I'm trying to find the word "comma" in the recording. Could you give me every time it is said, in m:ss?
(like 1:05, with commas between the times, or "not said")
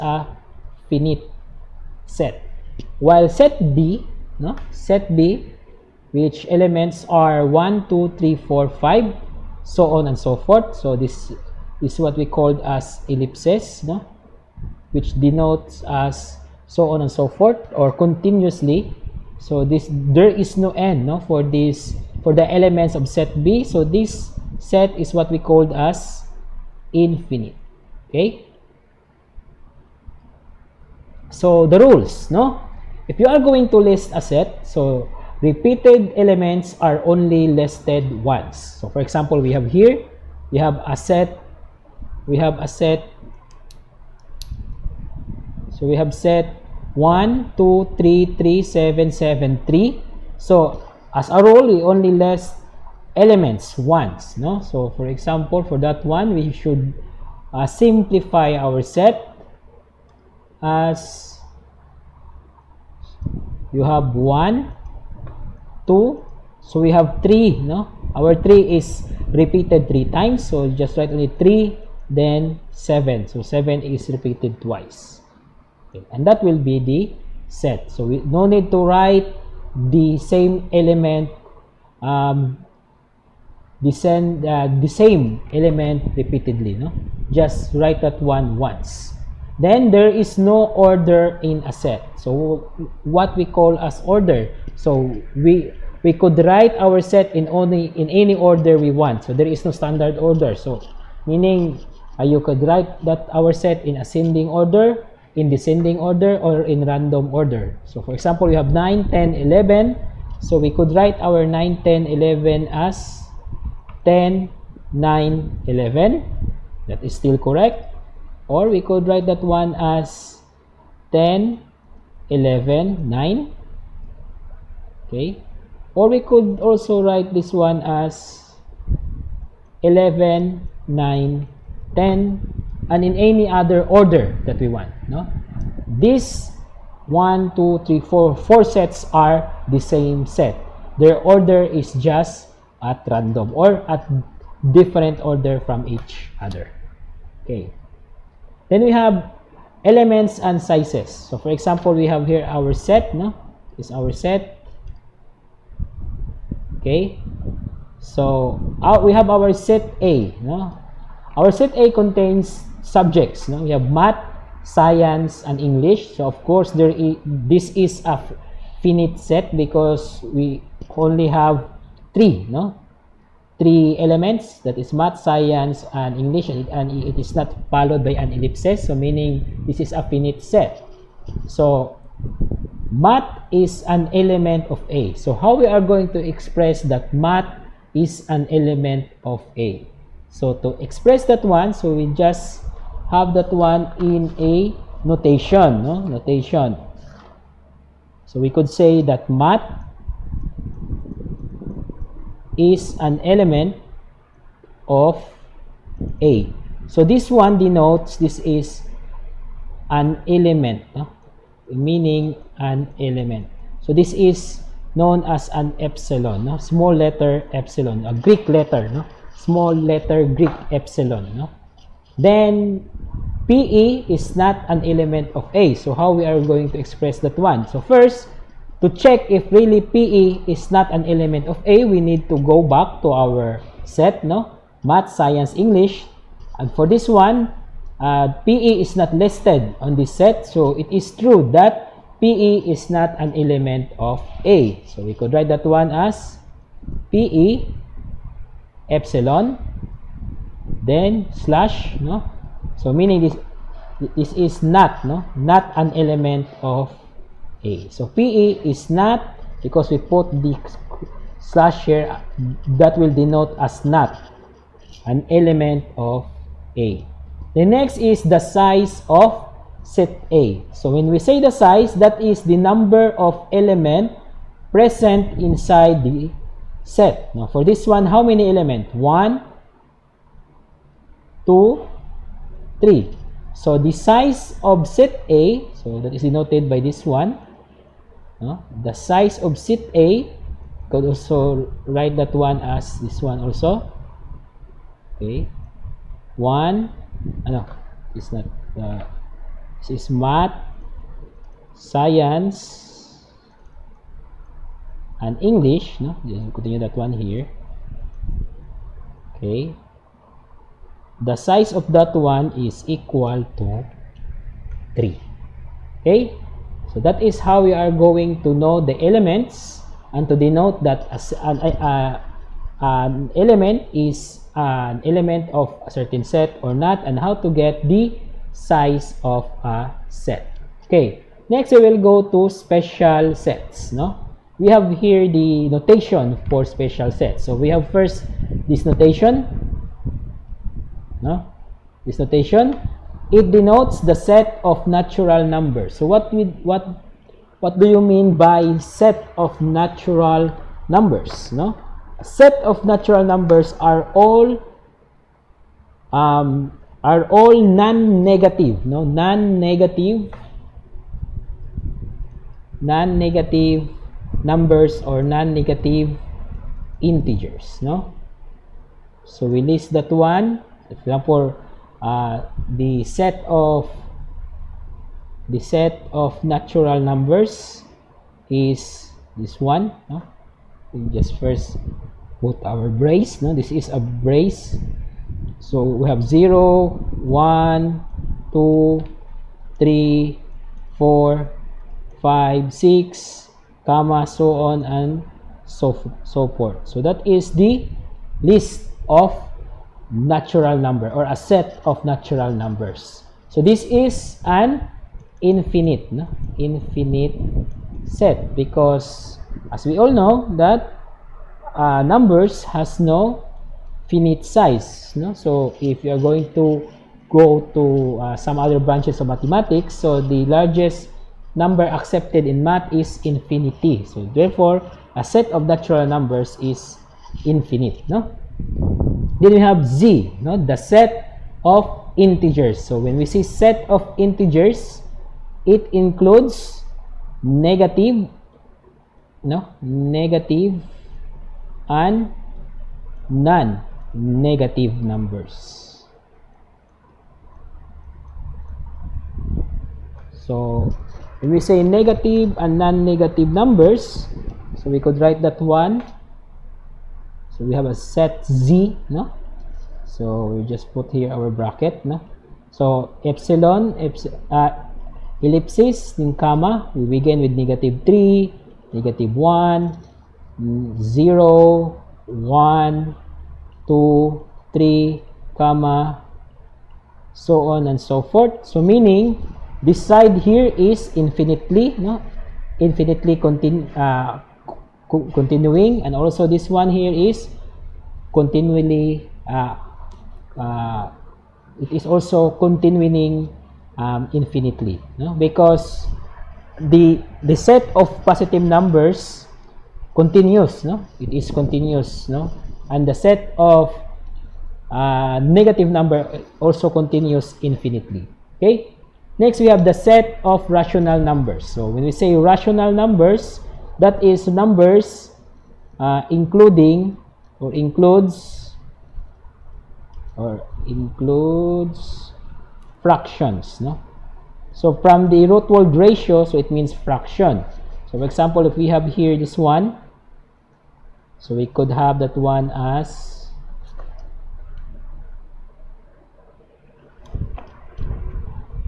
6:33, 7:46, 7:55.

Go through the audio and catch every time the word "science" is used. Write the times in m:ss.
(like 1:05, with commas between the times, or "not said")
2:44, 2:55, 3:55, 5:01.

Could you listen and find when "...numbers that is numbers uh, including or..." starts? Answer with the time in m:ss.
8:32.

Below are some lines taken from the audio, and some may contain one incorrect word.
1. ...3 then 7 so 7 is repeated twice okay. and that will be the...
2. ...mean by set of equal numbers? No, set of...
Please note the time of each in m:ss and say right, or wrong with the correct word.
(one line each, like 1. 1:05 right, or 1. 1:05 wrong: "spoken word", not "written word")
1. 1:11 right
2. 5:48 wrong: "natural", not "equal".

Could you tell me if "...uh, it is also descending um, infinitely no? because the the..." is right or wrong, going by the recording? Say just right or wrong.
wrong.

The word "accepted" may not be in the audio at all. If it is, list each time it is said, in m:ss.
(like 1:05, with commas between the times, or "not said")
7:01.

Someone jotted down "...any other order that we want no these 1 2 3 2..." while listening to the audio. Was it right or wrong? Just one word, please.
wrong.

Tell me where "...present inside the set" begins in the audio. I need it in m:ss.
4:34.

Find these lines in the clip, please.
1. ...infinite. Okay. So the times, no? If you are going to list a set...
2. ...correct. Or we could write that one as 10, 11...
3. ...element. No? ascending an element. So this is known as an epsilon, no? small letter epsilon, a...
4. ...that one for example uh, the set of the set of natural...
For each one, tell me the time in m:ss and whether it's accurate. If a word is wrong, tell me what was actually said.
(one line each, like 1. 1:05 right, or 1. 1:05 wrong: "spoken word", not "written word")
1. 0:26 wrong: "rules", not "times"
2. 1:57 right
3. 3:30 wrong: "meaning", not "ascending"
4. 6:09 right.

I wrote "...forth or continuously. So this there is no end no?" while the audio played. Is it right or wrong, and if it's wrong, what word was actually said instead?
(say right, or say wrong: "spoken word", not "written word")
right.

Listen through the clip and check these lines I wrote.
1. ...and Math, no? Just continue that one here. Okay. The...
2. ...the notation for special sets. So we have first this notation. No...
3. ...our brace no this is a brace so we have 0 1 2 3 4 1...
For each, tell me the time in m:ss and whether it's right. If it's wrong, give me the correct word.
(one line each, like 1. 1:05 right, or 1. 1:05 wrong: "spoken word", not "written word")
1. 5:05 wrong: "English", not "Math"
2. 5:35 right
3. 6:22 wrong: "5", not "1".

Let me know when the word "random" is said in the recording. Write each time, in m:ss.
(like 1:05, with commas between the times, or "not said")
1:46, 2:23.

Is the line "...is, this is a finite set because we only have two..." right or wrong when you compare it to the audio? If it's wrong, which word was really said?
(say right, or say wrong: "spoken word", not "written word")
wrong: "three", not "two".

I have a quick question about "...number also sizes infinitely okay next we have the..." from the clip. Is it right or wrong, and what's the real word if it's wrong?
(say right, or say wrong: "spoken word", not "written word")
wrong: "continues", not "sizes".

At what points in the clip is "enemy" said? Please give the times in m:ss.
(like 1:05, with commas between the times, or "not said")
not said.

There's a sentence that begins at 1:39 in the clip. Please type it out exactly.
So there is no standard order.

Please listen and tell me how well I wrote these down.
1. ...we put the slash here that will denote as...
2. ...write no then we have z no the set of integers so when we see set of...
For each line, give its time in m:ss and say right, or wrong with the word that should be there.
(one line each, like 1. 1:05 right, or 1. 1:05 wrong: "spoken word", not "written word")
1. 4:19 right
2. 7:07 wrong: "infinite", not "write".